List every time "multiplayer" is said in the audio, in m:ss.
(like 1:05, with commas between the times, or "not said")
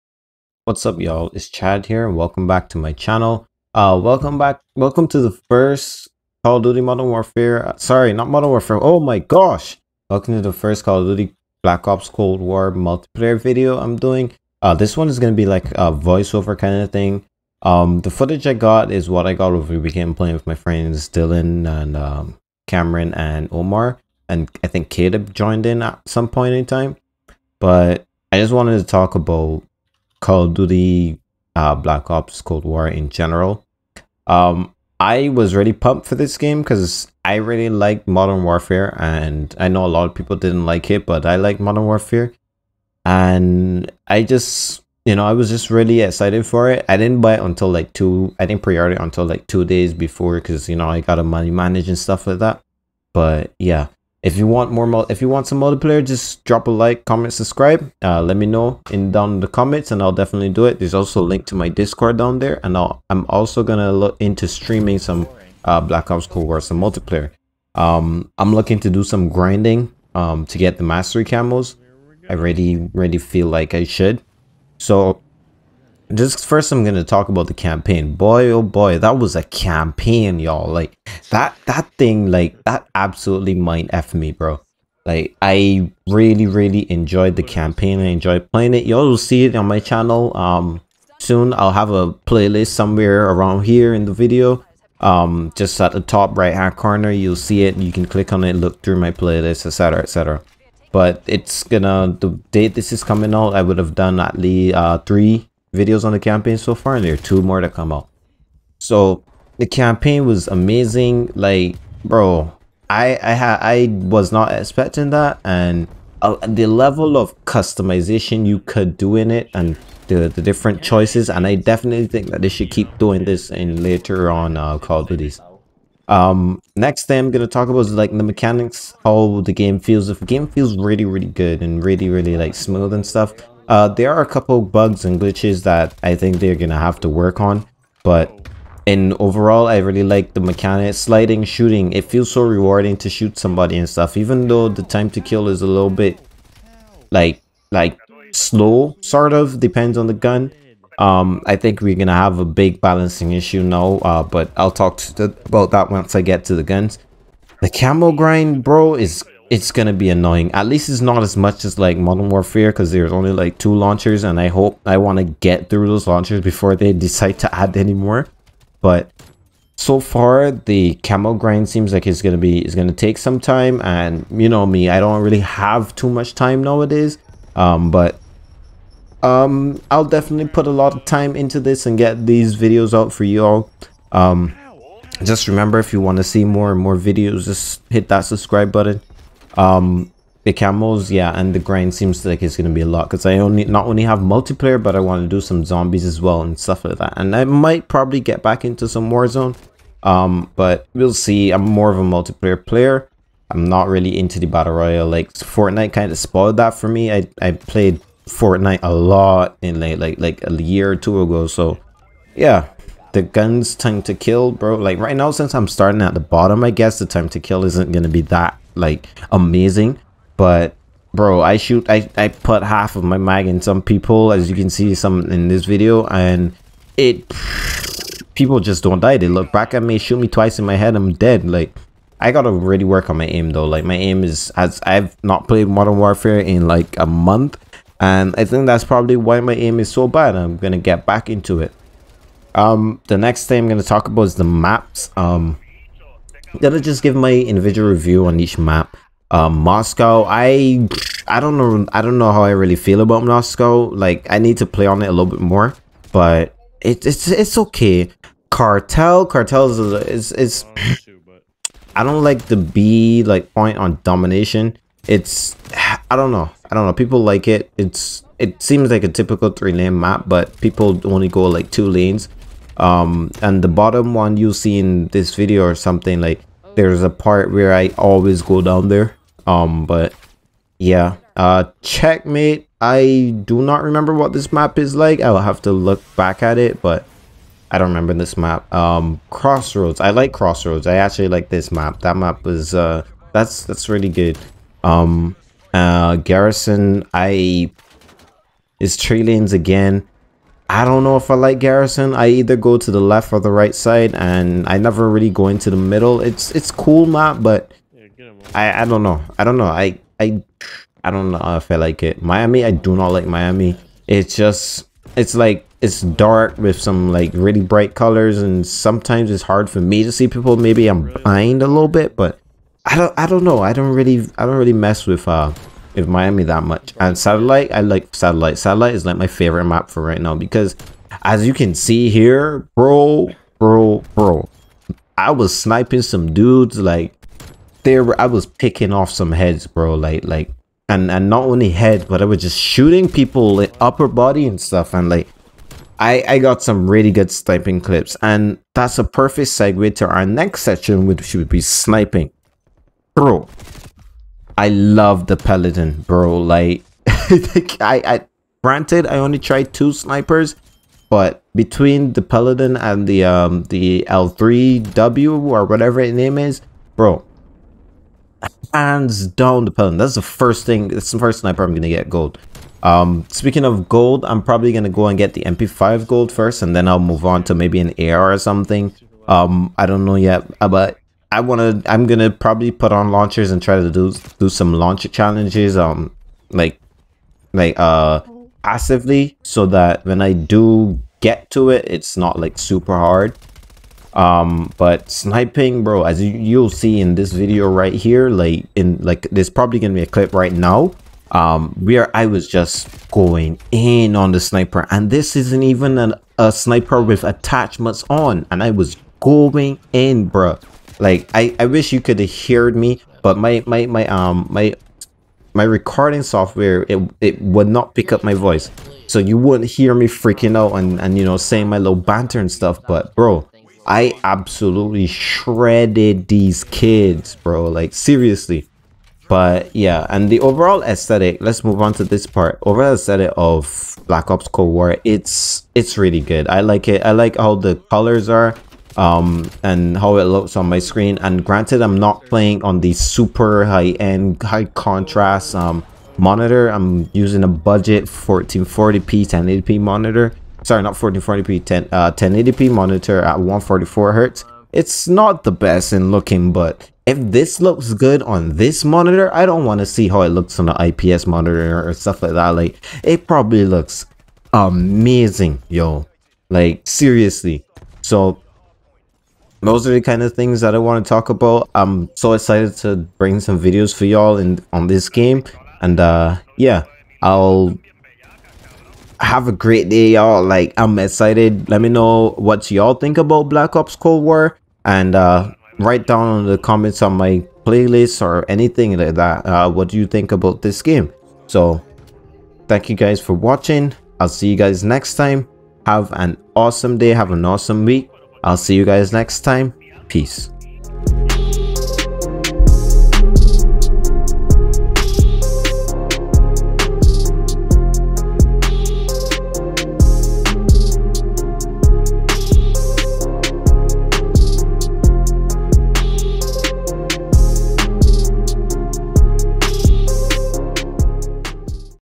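0:12, 0:55, 1:06, 3:14, 3:22.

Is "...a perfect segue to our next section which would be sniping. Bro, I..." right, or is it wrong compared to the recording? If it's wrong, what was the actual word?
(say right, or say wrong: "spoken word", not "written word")
right.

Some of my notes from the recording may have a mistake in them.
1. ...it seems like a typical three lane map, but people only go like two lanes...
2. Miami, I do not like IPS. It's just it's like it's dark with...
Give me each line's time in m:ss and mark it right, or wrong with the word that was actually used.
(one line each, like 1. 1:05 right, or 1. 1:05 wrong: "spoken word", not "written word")
1. 4:28 right
2. 5:12 wrong: "Miami", not "IPS".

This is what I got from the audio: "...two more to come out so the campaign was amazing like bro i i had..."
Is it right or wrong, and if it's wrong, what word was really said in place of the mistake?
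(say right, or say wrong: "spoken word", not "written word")
right.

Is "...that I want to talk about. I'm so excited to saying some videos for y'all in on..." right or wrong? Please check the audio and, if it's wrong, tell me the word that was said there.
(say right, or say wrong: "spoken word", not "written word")
wrong: "bring", not "saying".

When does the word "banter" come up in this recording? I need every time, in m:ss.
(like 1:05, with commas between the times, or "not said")
7:01.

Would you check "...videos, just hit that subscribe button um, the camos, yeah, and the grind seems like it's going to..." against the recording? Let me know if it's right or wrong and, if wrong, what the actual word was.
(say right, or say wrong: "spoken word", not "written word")
right.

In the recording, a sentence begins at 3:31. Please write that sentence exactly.
So yeah, the guns time to kill, bro.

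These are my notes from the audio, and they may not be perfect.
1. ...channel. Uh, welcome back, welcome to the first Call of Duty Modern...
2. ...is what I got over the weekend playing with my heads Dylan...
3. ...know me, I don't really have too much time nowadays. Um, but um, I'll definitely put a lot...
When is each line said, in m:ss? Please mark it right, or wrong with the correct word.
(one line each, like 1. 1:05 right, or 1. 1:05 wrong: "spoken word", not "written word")
1. 0:02 right
2. 0:18 wrong: "friends", not "heads"
3. 2:54 right.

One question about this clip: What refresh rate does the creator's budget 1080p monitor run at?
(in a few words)
144 hertz.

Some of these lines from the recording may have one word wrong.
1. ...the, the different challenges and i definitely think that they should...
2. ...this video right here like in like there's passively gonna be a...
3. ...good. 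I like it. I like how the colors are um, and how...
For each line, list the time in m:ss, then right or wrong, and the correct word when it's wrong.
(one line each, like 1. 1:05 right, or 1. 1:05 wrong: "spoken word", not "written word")
1. 2:00 wrong: "choices", not "challenges"
2. 6:37 wrong: "probably", not "passively"
3. 7:16 right.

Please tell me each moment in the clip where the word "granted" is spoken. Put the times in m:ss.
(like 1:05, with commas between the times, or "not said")
5:58, 7:21.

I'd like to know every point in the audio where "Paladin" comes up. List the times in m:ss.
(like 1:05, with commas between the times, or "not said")
5:55, 6:02, 6:09.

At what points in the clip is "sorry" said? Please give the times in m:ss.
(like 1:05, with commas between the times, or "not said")
0:07, 7:30.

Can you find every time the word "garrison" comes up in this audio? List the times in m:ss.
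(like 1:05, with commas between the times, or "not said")
4:56, 5:01.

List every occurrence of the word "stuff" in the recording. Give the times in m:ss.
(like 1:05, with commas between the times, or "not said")
0:51, 2:13, 2:23, 3:16, 5:44, 7:02, 7:41.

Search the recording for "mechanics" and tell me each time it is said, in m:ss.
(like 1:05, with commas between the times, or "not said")
2:08, 2:20.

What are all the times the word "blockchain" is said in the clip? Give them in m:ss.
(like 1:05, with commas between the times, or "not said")
not said.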